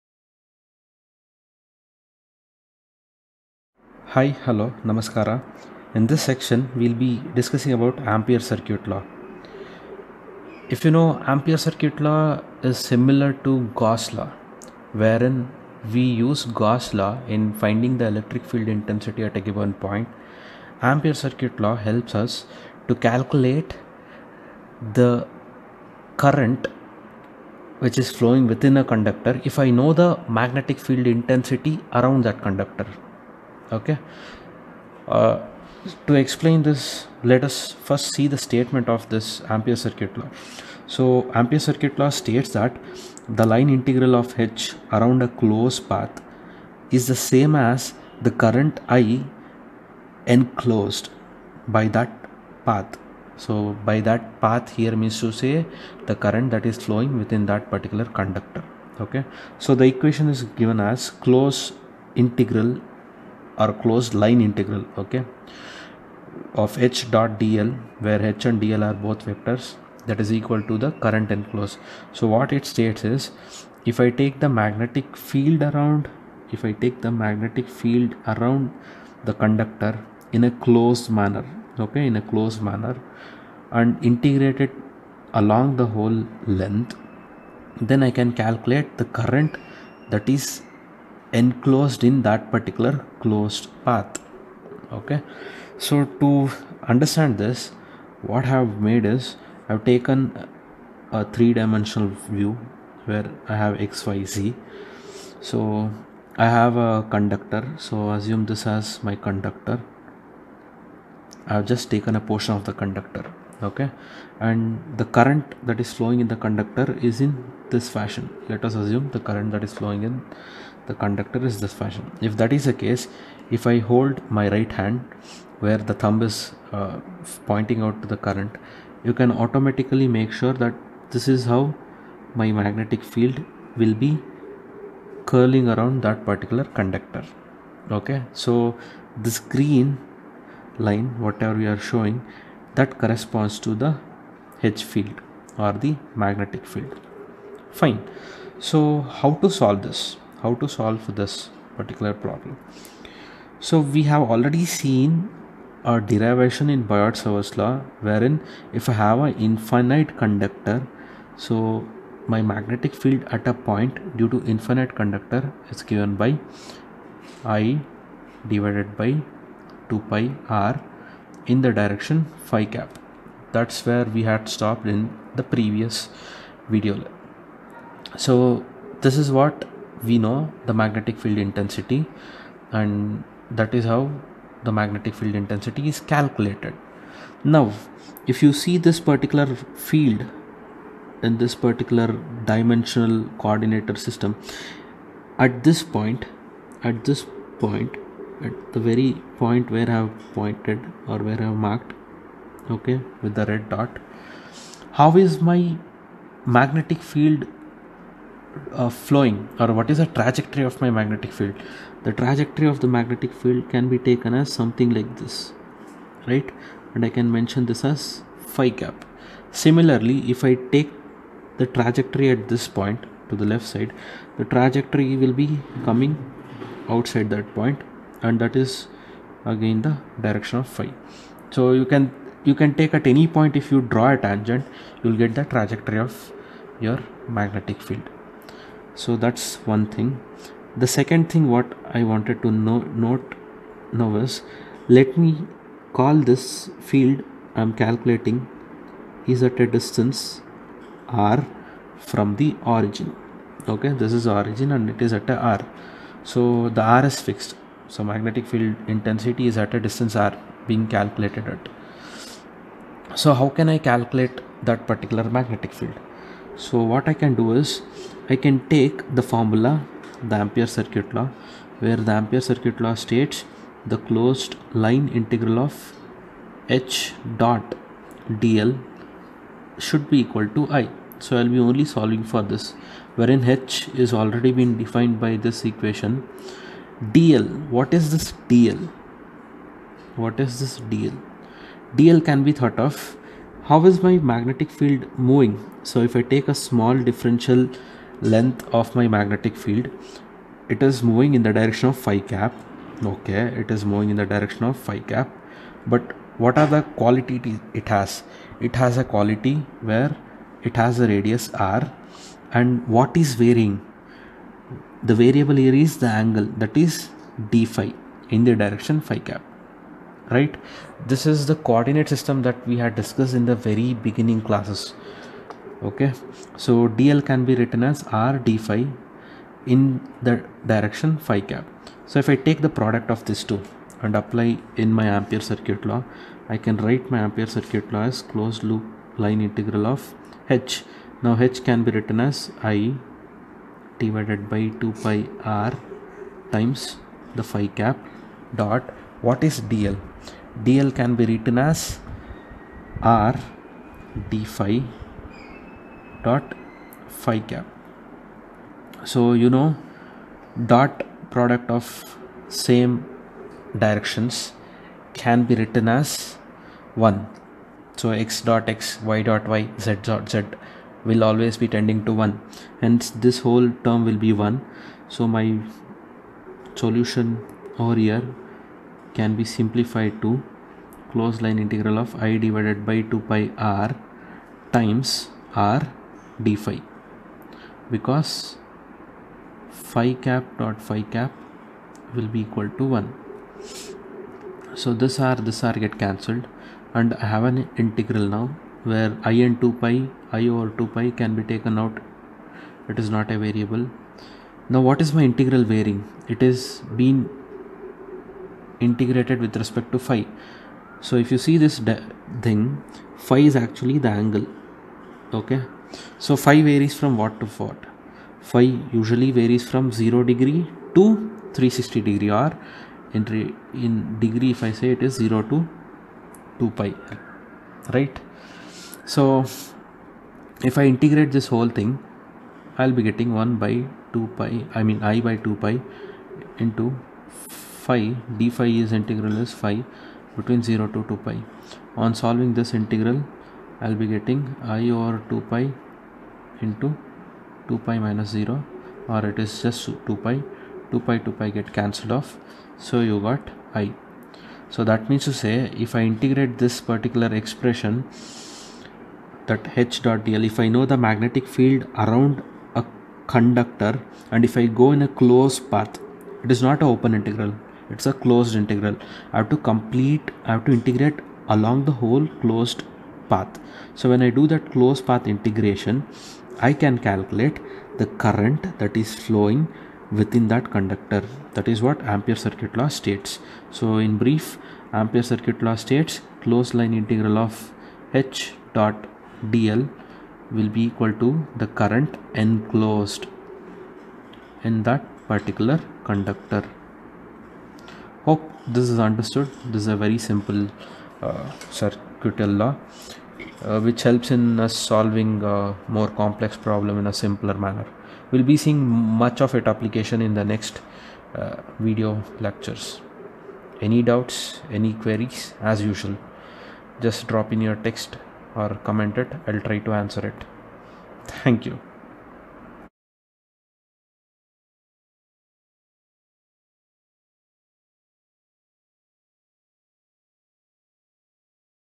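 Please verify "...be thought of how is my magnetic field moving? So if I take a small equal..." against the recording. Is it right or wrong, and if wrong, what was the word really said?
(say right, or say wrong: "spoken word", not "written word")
wrong: "differential", not "equal".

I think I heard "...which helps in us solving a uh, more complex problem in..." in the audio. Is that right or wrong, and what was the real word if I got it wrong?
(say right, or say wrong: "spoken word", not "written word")
right.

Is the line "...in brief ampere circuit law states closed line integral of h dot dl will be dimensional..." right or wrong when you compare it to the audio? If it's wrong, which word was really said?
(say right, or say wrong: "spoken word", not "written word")
wrong: "equal", not "dimensional".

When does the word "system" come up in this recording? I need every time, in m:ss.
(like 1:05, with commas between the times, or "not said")
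3:13, 5:22.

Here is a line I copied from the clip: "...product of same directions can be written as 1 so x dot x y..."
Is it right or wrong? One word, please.
right.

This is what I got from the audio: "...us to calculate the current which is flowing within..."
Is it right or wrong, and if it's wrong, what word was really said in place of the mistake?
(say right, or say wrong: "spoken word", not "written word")
right.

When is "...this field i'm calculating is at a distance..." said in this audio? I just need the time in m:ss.
4:06.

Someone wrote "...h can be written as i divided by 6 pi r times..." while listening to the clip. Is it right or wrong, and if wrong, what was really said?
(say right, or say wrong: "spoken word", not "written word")
wrong: "2", not "6".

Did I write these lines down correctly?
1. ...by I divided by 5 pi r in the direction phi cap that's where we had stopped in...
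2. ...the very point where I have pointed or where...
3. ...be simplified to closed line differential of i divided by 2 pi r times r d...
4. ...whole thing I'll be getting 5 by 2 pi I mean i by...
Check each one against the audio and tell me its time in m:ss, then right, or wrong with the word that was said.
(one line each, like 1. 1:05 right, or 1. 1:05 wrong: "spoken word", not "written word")
1. 2:46 wrong: "2", not "5"
2. 3:18 right
3. 6:19 wrong: "integral", not "differential"
4. 7:11 wrong: "1", not "5".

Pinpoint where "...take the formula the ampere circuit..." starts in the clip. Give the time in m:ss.
4:28.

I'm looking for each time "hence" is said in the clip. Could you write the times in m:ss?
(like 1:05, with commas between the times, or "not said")
6:12.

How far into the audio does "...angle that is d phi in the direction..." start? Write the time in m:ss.
5:16.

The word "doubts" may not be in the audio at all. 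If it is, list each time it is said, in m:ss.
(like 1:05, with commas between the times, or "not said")
8:34.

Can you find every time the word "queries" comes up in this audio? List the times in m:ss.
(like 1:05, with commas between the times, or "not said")
8:34.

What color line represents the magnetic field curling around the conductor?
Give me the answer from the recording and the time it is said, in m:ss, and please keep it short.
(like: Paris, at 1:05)
Green, at 2:19.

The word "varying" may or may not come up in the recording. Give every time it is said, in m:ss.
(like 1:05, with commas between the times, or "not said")
5:13, 6:45.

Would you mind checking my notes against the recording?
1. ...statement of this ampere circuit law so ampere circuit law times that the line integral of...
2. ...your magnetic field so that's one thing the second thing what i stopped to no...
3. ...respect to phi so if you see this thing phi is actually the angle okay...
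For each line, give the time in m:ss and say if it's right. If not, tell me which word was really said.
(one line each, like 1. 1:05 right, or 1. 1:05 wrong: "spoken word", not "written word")
1. 0:38 wrong: "states", not "times"
2. 3:56 wrong: "wanted", not "stopped"
3. 6:49 right.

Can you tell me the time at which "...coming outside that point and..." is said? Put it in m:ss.
3:45.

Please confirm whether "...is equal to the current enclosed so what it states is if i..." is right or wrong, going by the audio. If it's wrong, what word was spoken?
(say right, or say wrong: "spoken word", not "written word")
right.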